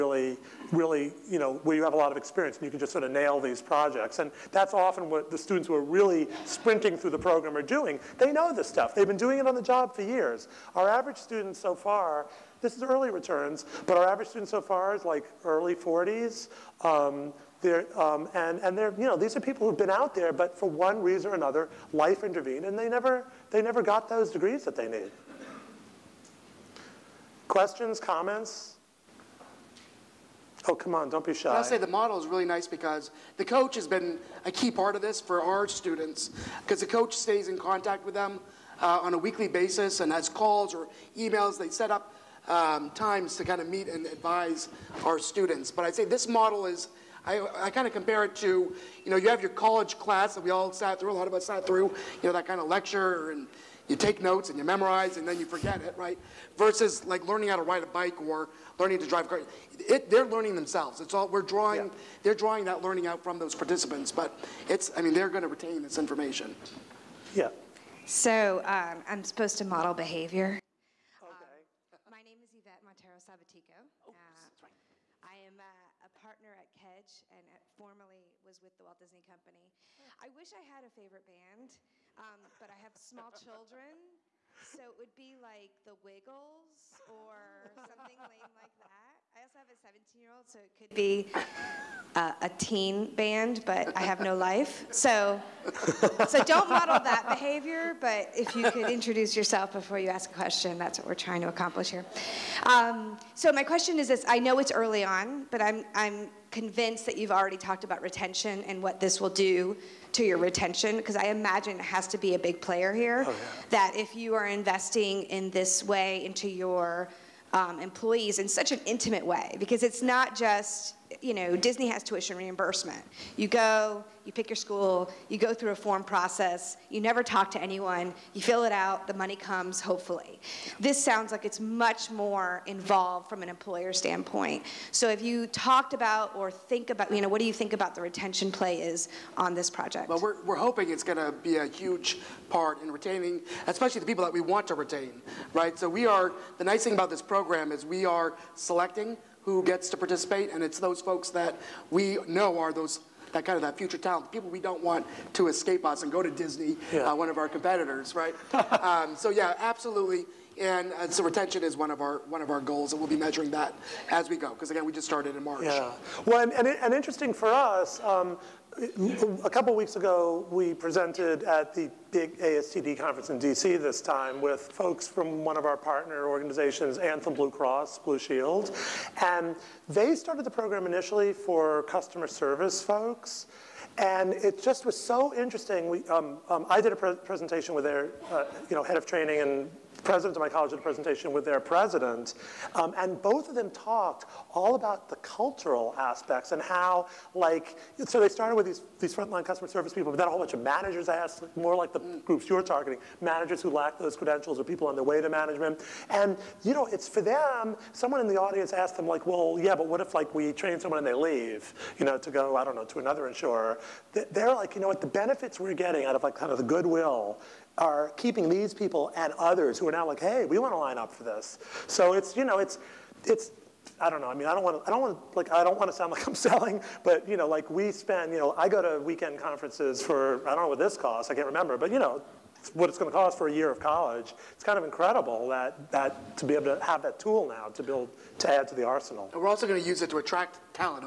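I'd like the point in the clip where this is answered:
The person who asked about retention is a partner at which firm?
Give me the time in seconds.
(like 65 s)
76 s.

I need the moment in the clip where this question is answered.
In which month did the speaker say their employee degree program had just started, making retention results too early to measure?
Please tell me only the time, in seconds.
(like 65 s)
165 s.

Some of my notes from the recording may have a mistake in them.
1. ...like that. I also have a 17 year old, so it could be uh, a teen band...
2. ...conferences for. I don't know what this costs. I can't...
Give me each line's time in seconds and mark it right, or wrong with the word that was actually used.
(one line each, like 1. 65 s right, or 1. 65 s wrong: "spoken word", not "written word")
1. 88 s right
2. 229 s right.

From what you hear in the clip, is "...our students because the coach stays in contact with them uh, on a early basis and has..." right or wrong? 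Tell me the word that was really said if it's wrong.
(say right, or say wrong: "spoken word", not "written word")
wrong: "weekly", not "early".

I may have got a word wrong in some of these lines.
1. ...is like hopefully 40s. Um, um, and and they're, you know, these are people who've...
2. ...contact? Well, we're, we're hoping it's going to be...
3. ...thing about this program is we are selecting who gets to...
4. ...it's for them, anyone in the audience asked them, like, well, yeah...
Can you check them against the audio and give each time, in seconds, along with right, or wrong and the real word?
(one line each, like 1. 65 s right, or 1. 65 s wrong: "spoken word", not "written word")
1. 14 s wrong: "early", not "hopefully"
2. 139 s wrong: "project", not "contact"
3. 146 s right
4. 206 s wrong: "someone", not "anyone".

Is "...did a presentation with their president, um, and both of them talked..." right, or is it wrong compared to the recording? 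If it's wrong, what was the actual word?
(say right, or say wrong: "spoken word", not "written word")
right.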